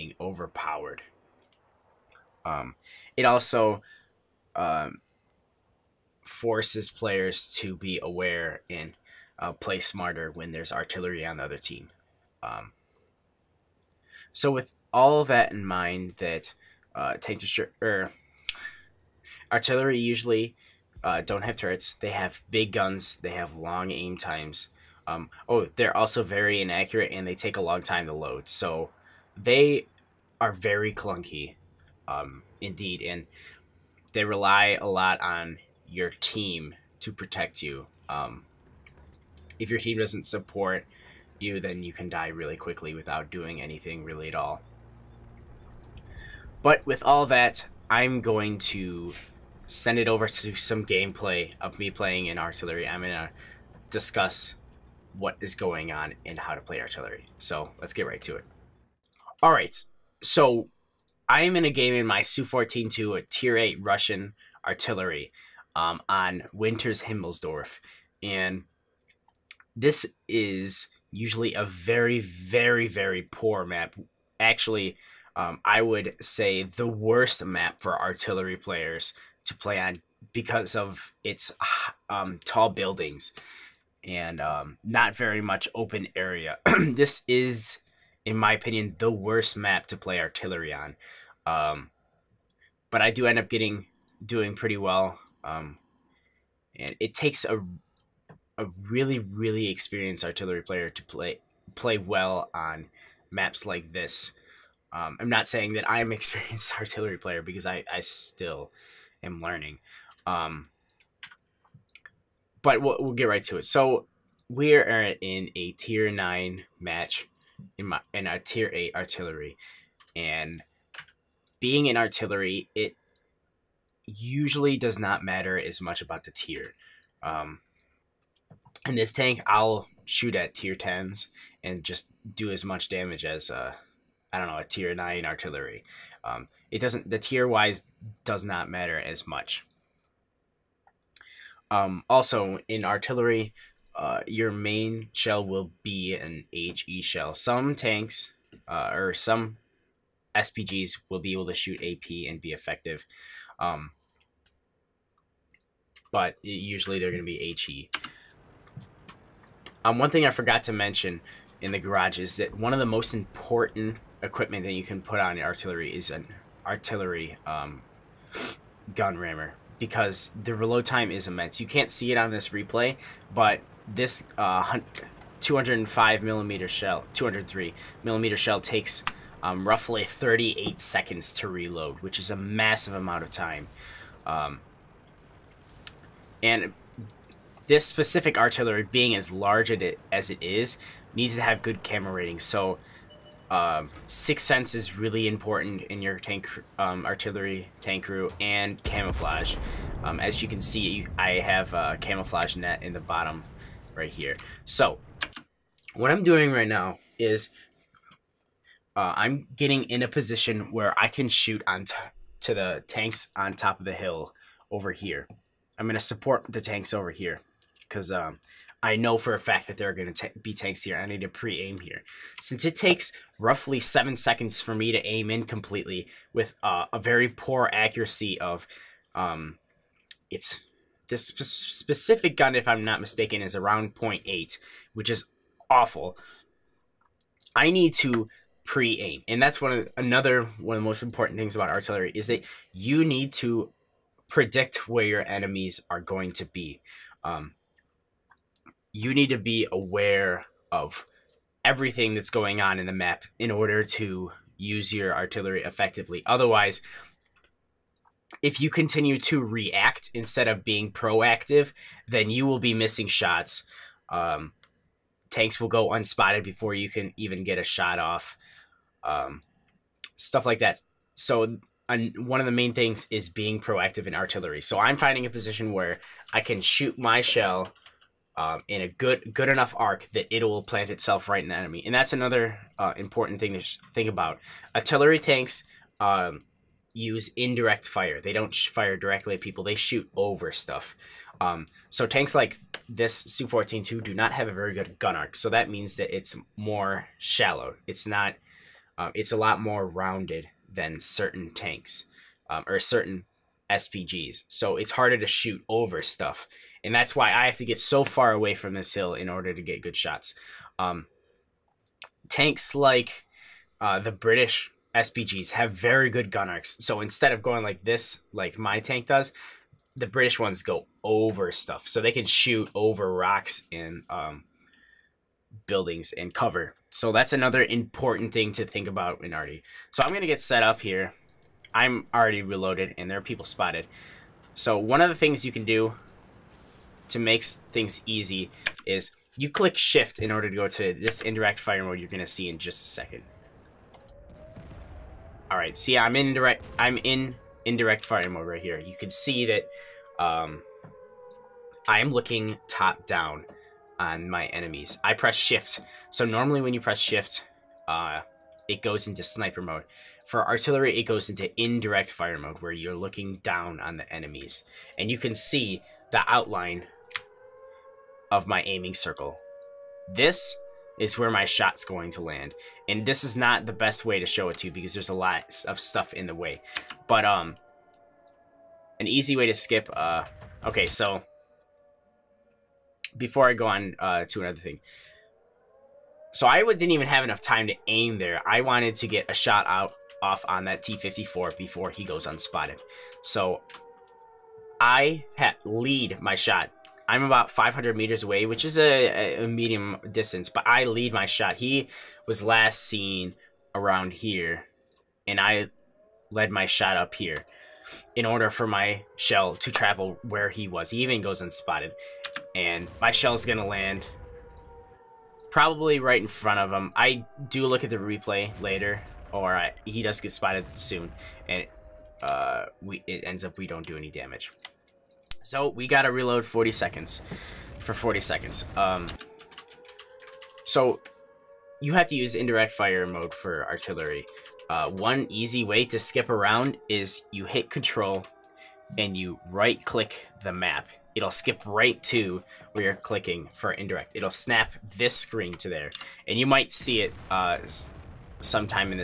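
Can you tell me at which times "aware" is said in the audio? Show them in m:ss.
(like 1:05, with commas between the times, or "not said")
0:08, 4:09.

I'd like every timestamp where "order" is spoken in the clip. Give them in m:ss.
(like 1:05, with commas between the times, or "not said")
4:13, 5:09, 5:40, 6:48.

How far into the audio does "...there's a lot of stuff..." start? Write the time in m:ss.
6:14.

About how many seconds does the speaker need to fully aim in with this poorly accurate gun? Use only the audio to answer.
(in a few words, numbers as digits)
7 seconds.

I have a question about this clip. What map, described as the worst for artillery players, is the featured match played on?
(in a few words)
Winters Himmelsdorf.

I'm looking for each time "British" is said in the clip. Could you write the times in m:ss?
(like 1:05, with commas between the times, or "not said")
5:14, 5:20.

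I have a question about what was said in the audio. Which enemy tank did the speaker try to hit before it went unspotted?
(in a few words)
T-54.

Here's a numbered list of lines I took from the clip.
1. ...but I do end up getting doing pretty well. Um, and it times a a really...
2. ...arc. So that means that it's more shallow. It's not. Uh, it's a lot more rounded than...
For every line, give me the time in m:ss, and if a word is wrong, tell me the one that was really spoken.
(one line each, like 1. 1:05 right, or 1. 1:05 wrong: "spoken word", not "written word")
1. 1:32 wrong: "takes", not "times"
2. 4:55 right.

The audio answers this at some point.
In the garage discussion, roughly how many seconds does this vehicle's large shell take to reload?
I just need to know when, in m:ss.
3:00.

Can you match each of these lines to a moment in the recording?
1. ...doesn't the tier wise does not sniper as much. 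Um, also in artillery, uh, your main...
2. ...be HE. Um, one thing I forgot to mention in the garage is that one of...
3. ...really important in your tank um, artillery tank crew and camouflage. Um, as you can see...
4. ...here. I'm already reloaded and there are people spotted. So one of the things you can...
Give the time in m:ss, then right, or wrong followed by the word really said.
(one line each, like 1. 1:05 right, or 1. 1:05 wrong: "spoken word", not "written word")
1. 2:16 wrong: "matter", not "sniper"
2. 2:37 right
3. 3:14 right
4. 5:30 right.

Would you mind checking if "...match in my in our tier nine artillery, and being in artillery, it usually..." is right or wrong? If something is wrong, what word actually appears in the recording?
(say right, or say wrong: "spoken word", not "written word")
wrong: "eight", not "nine".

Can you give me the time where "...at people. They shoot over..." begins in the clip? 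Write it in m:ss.
4:49.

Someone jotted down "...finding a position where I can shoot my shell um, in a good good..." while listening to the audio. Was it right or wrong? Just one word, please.
right.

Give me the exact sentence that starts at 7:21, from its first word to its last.
It'll skip right to where you're clicking for indirect.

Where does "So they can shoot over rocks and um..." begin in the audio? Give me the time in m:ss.
5:21.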